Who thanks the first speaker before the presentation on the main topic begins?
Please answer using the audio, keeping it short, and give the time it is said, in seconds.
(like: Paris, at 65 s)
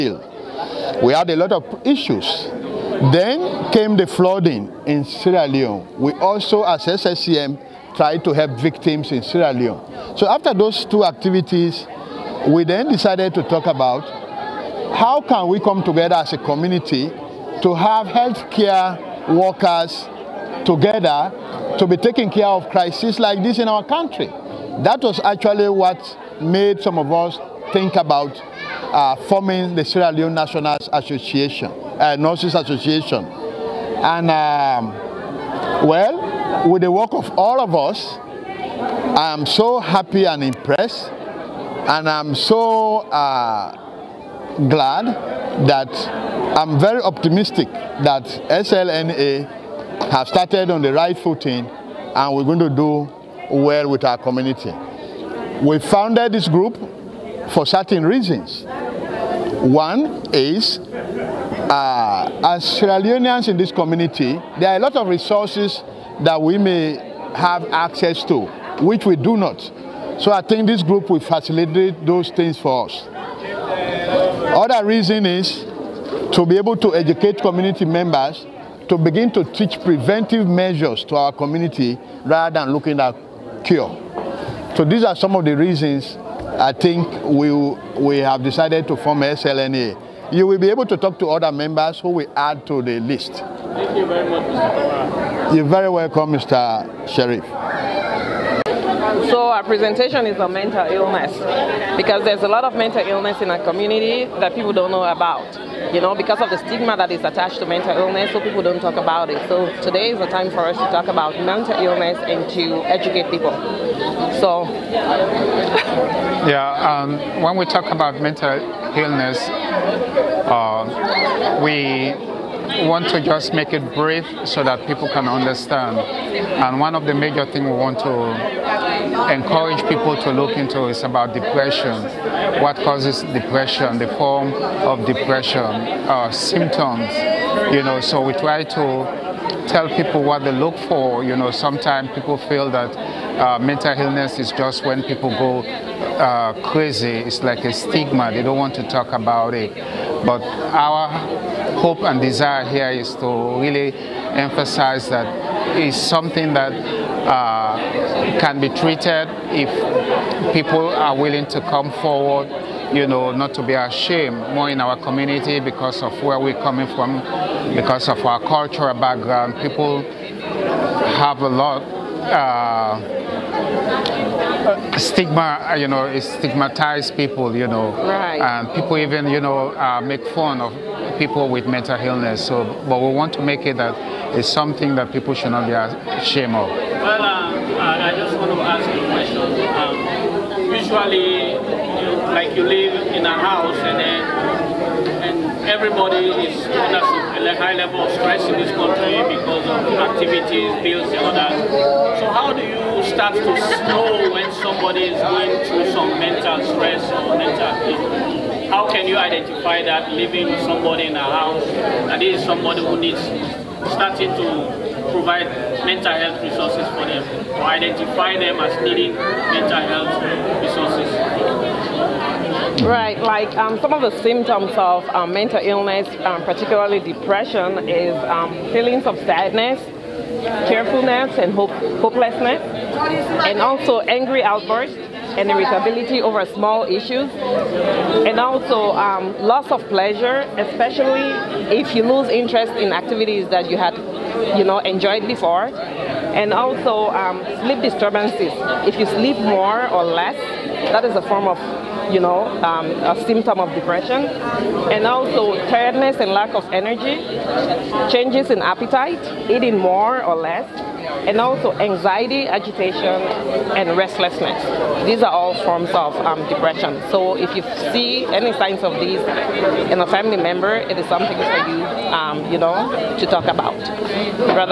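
Mr. Sheriff, at 96 s.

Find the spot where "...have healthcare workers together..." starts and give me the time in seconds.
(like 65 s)
17 s.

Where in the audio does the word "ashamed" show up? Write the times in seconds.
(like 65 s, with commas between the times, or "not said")
163 s, 185 s.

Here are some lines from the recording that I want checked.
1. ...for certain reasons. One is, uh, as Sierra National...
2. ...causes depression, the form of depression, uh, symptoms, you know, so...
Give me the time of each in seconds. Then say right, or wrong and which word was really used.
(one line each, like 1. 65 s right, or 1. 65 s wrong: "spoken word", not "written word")
1. 57 s wrong: "Leoneans", not "National"
2. 132 s right.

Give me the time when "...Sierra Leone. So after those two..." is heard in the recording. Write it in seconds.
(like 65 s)
9 s.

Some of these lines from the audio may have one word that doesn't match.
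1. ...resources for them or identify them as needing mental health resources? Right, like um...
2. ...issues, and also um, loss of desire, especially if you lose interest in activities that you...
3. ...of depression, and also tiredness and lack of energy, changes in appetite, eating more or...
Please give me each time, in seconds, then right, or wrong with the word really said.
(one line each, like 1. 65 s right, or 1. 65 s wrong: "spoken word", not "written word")
1. 216 s right
2. 236 s wrong: "pleasure", not "desire"
3. 253 s right.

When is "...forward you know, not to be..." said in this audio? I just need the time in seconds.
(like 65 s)
161 s.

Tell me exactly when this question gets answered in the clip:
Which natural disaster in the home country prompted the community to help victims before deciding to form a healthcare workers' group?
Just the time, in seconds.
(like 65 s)
4 s.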